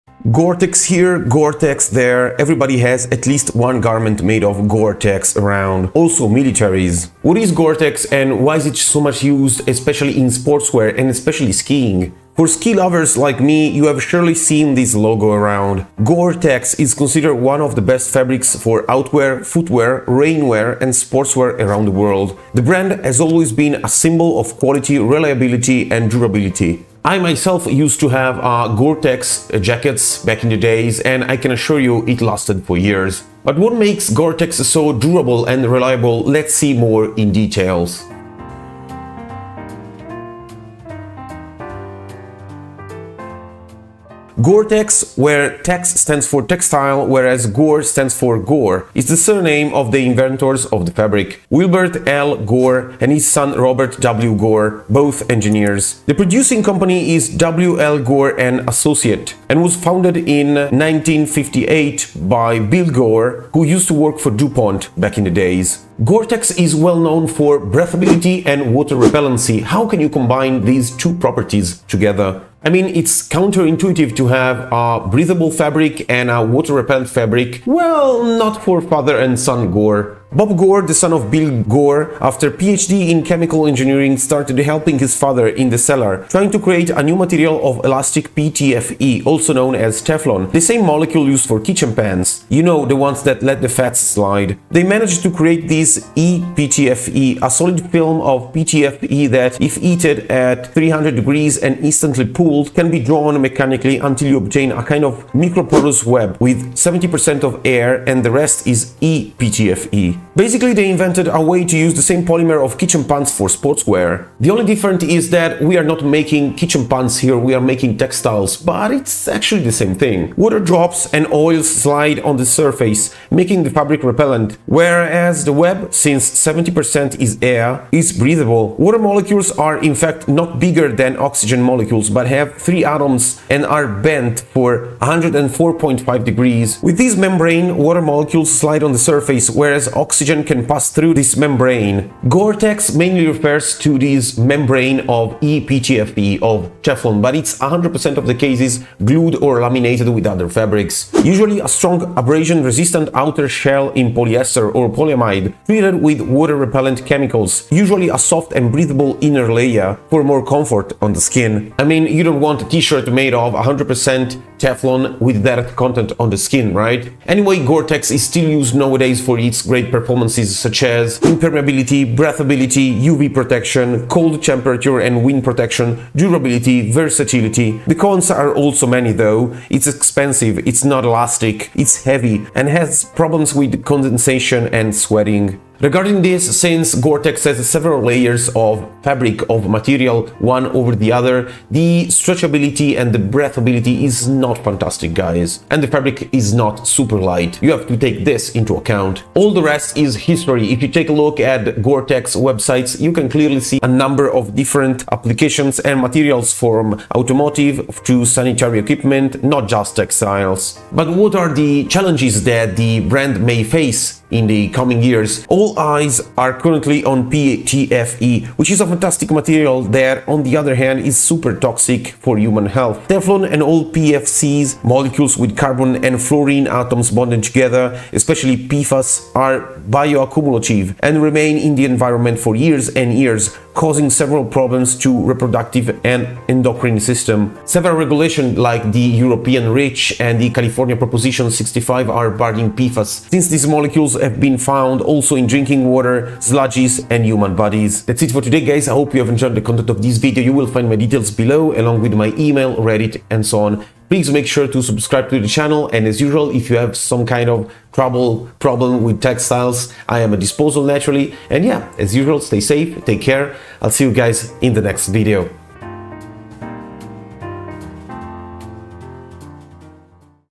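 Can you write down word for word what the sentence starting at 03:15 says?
And the fabric is not super light.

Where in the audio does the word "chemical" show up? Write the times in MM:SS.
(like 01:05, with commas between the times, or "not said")
01:23, 02:37.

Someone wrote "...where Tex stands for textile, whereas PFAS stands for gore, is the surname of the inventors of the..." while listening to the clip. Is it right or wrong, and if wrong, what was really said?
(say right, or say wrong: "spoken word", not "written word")
wrong: "Gore", not "PFAS".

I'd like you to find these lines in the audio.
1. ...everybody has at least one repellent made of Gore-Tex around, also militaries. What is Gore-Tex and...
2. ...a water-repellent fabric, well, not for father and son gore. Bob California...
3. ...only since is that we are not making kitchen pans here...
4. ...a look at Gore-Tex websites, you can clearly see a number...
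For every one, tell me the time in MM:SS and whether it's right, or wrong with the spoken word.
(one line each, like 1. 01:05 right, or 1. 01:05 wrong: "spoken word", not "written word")
1. 00:02 wrong: "garment", not "repellent"
2. 01:16 wrong: "Gore", not "California"
3. 01:54 wrong: "difference", not "since"
4. 03:21 right.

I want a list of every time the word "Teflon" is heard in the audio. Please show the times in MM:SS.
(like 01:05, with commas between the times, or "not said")
01:30, 02:26, 02:44, 03:43.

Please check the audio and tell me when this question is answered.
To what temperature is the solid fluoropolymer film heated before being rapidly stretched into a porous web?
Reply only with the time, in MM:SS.
01:40.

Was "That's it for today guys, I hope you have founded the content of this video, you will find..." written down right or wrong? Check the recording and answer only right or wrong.
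wrong.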